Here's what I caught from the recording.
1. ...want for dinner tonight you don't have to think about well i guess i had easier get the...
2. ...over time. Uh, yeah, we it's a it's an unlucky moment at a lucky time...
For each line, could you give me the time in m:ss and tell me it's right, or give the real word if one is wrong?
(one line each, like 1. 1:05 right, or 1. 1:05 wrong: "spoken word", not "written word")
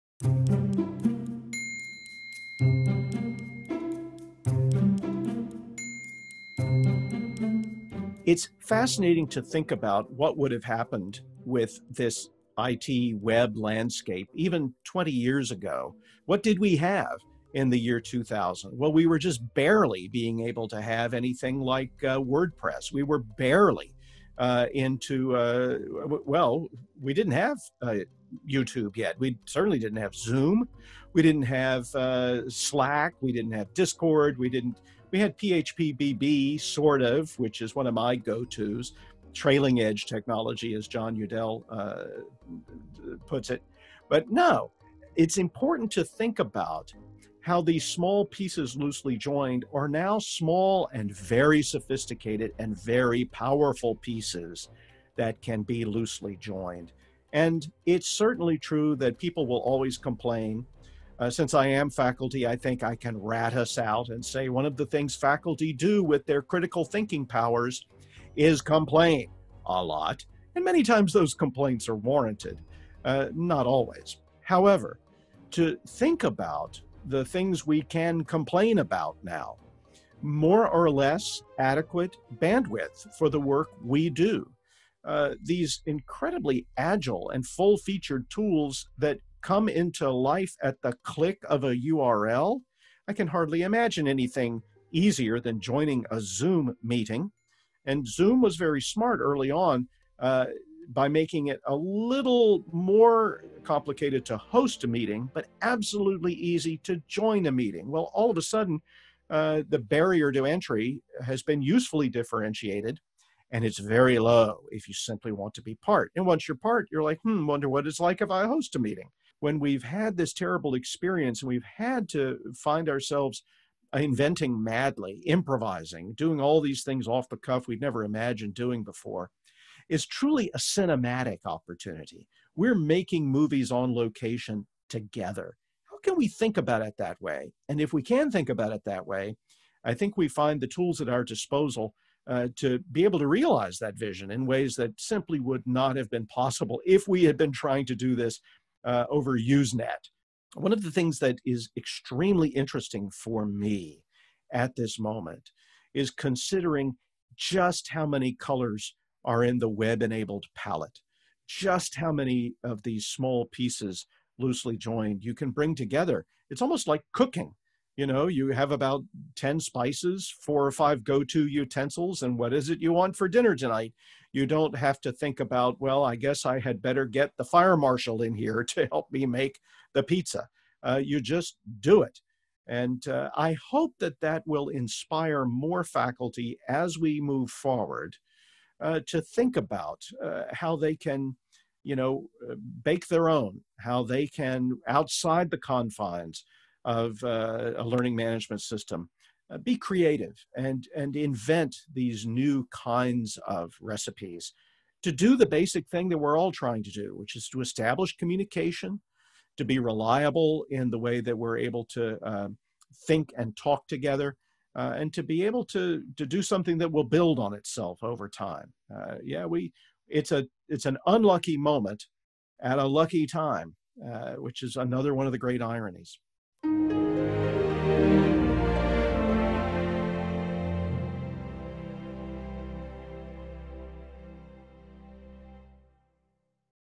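1. 2:52 wrong: "better", not "easier"
2. 3:38 right.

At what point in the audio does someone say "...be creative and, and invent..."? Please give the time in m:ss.
3:19.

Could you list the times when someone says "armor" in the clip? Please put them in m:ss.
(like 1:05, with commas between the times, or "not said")
not said.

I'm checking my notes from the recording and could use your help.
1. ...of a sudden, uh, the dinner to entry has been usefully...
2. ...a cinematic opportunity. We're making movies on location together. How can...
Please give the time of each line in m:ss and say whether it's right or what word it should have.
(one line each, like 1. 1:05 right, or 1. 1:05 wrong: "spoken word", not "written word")
1. 1:48 wrong: "barrier", not "dinner"
2. 2:10 right.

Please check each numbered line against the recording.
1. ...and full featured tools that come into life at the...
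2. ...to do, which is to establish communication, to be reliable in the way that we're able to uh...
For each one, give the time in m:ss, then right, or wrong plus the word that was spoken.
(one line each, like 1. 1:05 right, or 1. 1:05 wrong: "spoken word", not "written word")
1. 1:27 right
2. 3:26 right.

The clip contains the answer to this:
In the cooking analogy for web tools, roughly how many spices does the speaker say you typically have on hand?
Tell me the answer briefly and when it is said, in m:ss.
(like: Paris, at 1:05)
10, at 2:49.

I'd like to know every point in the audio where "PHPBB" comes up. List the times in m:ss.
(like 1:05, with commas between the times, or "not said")
0:35.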